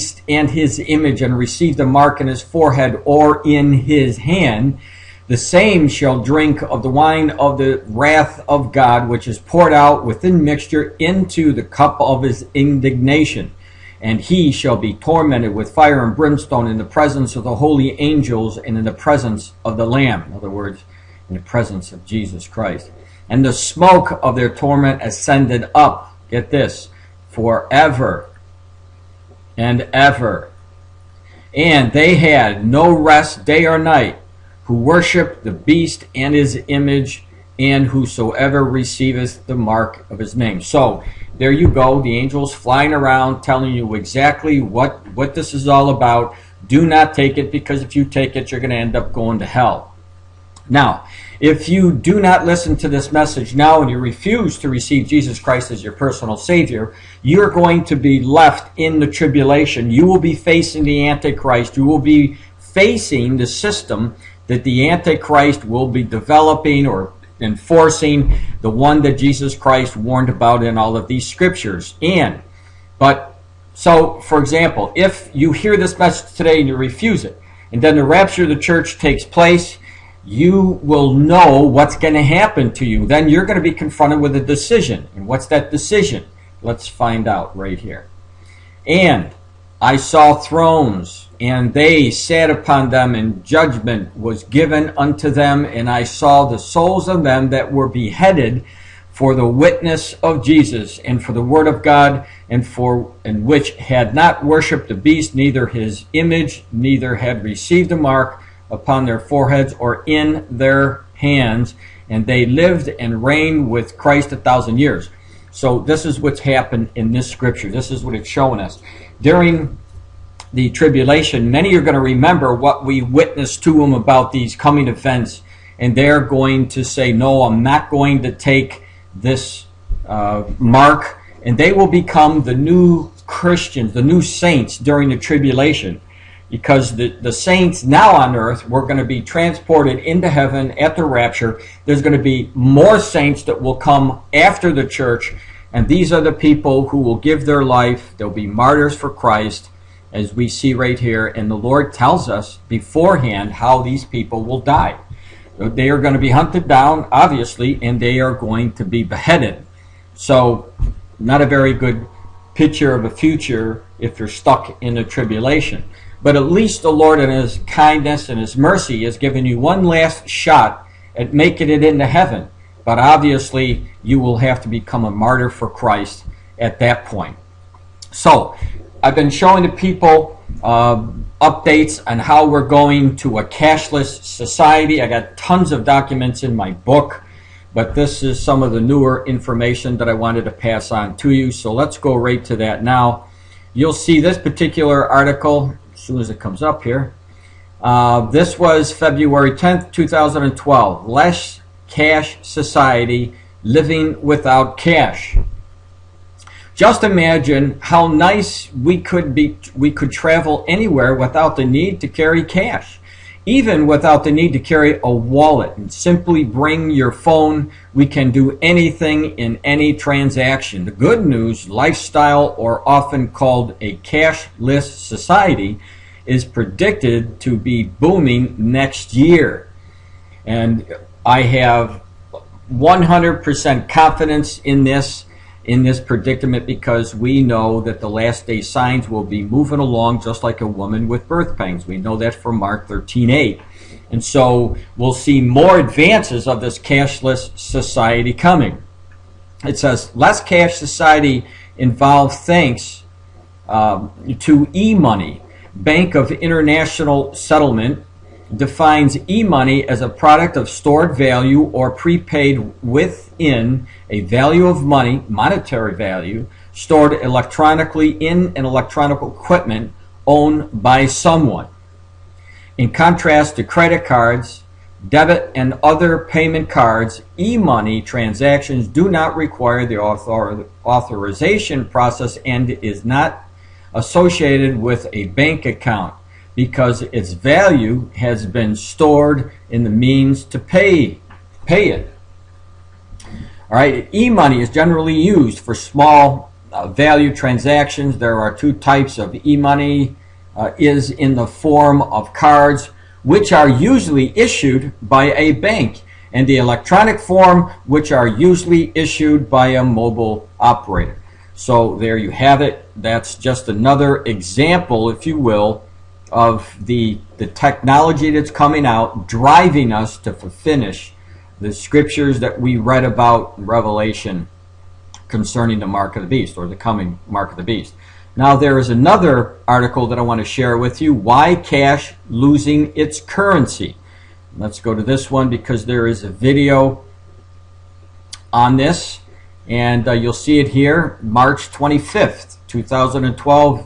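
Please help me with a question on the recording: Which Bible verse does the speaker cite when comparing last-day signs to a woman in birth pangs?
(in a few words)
Mark 13:8.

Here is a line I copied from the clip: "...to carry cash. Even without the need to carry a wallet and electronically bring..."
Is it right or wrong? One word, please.
wrong.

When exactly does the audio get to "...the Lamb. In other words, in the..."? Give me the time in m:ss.
0:19.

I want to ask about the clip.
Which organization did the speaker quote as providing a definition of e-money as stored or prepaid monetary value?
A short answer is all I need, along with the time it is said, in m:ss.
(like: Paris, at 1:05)
Bank of International Settlement, at 4:15.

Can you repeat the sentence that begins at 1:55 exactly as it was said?
So this is what's happened in this scripture.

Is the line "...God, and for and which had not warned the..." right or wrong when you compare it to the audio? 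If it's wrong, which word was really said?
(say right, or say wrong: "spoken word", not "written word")
wrong: "worshipped", not "warned".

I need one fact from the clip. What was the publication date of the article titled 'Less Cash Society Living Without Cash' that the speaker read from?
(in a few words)
February 10th, 2012.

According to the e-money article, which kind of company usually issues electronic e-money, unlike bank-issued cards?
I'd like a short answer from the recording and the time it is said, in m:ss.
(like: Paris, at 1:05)
A mobile operator, at 5:09.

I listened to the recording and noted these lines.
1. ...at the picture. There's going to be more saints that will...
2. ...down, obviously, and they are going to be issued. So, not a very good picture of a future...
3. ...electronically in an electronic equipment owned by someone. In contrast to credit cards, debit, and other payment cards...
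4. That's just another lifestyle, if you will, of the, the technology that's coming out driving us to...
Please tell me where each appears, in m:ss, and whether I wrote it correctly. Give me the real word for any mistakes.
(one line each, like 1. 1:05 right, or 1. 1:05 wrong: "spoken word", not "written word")
1. 2:20 wrong: "rapture", not "picture"
2. 2:36 wrong: "beheaded", not "issued"
3. 4:27 right
4. 5:12 wrong: "example", not "lifestyle".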